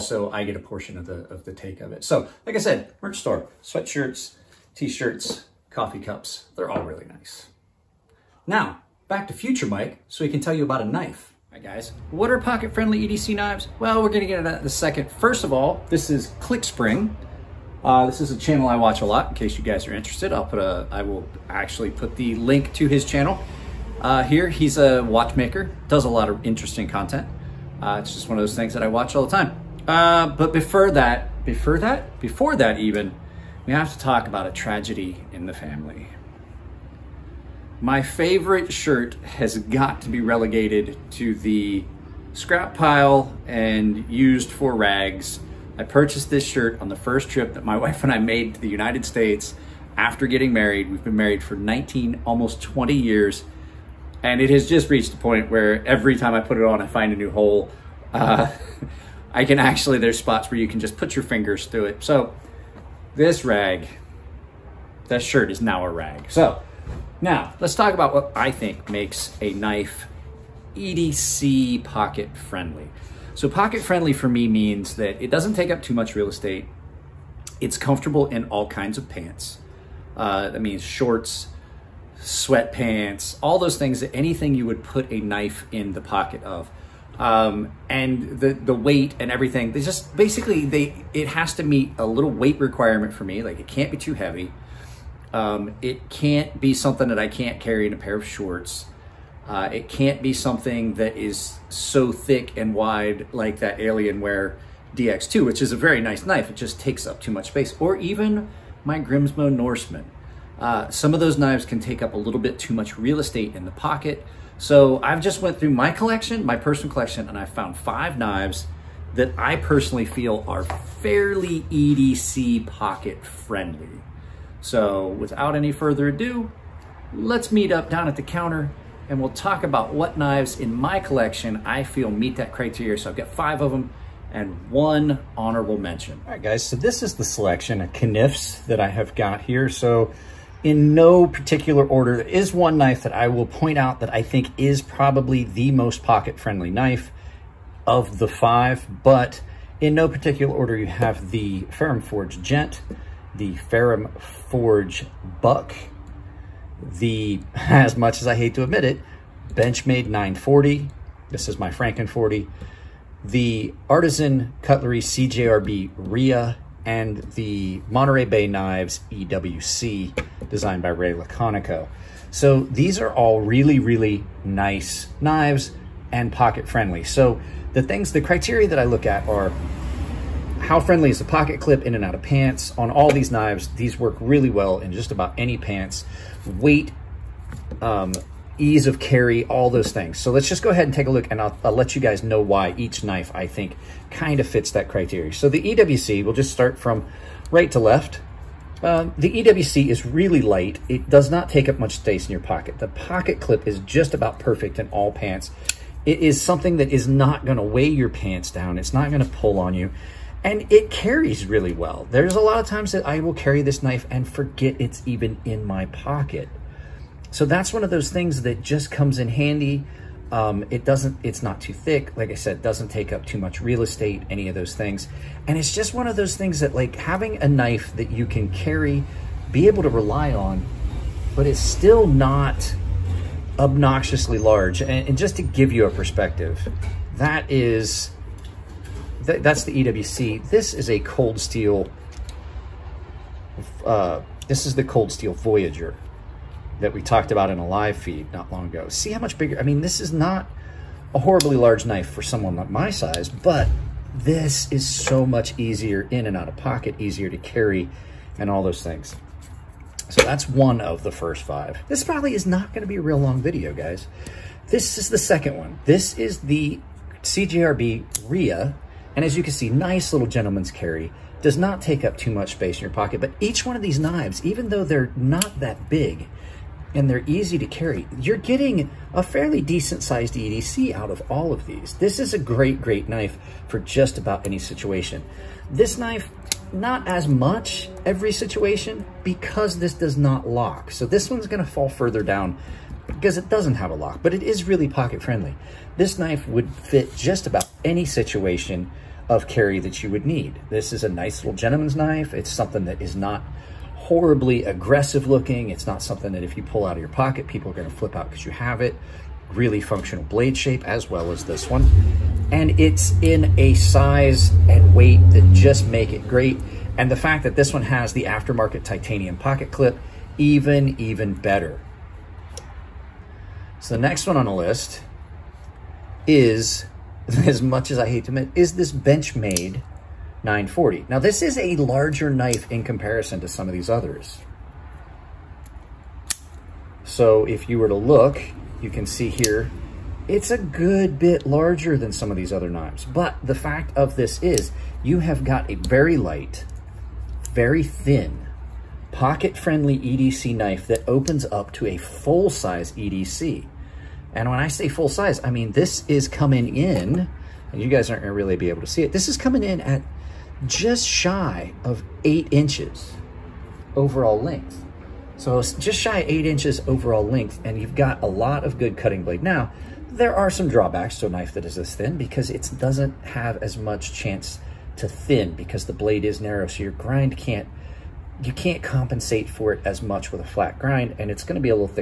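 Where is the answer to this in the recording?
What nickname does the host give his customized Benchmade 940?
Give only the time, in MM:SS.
02:41.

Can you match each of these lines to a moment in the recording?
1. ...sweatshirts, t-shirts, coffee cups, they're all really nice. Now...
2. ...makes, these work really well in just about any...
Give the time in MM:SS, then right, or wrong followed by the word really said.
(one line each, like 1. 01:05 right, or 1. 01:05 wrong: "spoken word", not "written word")
1. 00:03 right
2. 03:03 wrong: "knives", not "makes".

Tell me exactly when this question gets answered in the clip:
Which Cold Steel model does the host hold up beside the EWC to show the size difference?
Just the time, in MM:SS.
04:05.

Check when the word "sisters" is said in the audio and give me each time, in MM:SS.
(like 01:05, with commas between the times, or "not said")
not said.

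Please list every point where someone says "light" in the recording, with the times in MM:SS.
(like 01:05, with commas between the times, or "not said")
03:20, 05:46.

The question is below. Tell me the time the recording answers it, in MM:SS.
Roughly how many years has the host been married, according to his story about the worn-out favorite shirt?
00:51.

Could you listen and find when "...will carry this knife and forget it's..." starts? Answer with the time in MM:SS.
03:33.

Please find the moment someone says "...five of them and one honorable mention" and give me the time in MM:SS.
02:13.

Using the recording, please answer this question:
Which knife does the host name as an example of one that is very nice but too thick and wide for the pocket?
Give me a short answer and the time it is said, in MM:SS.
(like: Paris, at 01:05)
Alienware DX2, at 01:43.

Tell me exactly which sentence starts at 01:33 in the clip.
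Like it can't be too heavy.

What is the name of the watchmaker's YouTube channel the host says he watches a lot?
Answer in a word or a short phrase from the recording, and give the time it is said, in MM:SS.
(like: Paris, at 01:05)
ClickSpring, at 00:16.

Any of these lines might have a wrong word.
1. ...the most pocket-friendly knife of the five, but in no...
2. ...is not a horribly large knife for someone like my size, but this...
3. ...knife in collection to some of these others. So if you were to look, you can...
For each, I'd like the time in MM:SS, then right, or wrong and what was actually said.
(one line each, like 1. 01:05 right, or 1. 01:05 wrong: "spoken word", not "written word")
1. 02:25 right
2. 04:10 right
3. 05:32 wrong: "comparison", not "collection".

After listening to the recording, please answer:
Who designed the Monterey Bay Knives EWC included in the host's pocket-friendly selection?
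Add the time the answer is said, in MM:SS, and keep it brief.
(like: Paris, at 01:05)
Ray Laconico, at 02:50.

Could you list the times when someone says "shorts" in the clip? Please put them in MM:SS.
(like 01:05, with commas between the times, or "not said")
01:20, 01:38.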